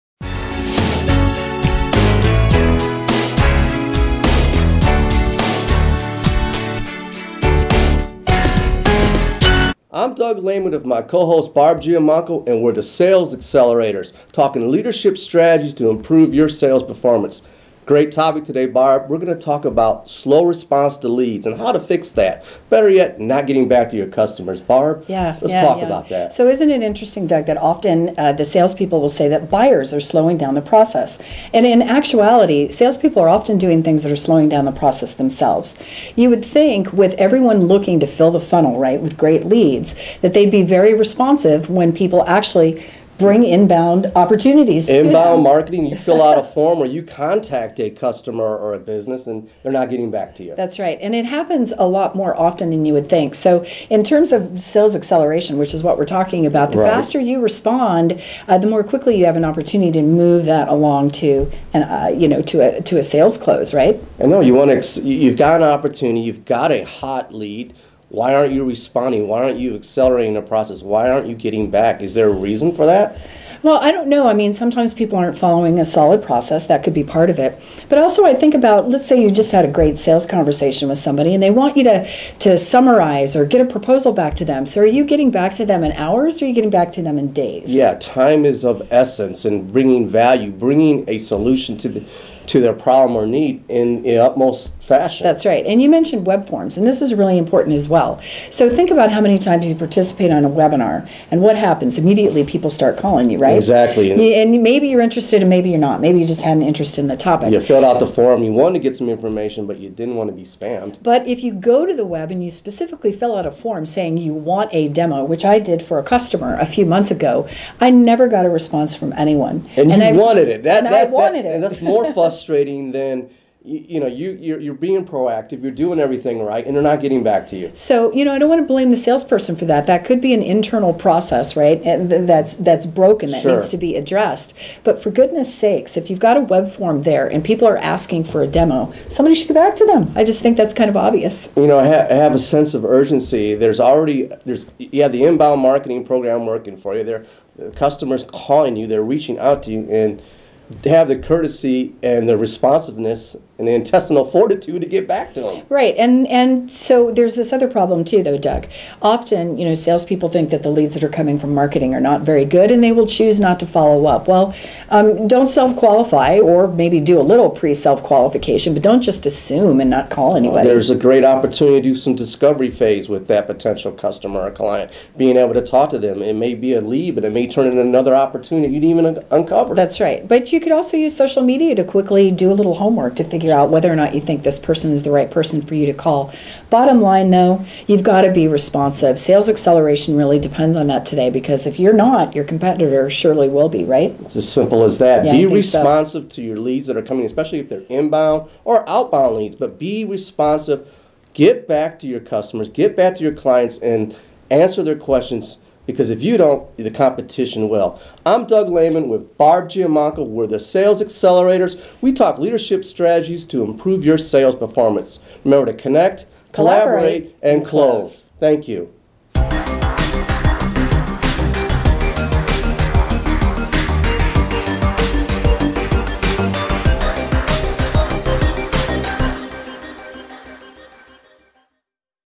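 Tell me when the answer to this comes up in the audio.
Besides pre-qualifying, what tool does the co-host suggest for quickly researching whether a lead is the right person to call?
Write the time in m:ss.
3:01.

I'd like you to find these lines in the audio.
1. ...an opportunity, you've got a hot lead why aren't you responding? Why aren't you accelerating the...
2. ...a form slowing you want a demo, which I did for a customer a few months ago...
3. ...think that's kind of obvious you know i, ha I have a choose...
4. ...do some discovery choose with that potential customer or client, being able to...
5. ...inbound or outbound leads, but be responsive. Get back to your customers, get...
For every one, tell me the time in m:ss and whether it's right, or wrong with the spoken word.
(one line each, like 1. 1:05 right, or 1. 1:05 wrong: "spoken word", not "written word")
1. 1:05 right
2. 1:53 wrong: "saying", not "slowing"
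3. 2:20 wrong: "sense", not "choose"
4. 2:51 wrong: "phase", not "choose"
5. 3:17 right.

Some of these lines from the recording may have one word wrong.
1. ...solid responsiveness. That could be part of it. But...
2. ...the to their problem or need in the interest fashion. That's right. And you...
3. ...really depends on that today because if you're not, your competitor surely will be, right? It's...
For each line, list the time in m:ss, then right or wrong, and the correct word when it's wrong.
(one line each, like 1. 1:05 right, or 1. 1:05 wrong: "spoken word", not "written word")
1. 1:15 wrong: "process", not "responsiveness"
2. 1:31 wrong: "utmost", not "interest"
3. 3:10 right.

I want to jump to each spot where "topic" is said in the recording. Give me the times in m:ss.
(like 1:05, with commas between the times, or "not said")
0:18, 1:47.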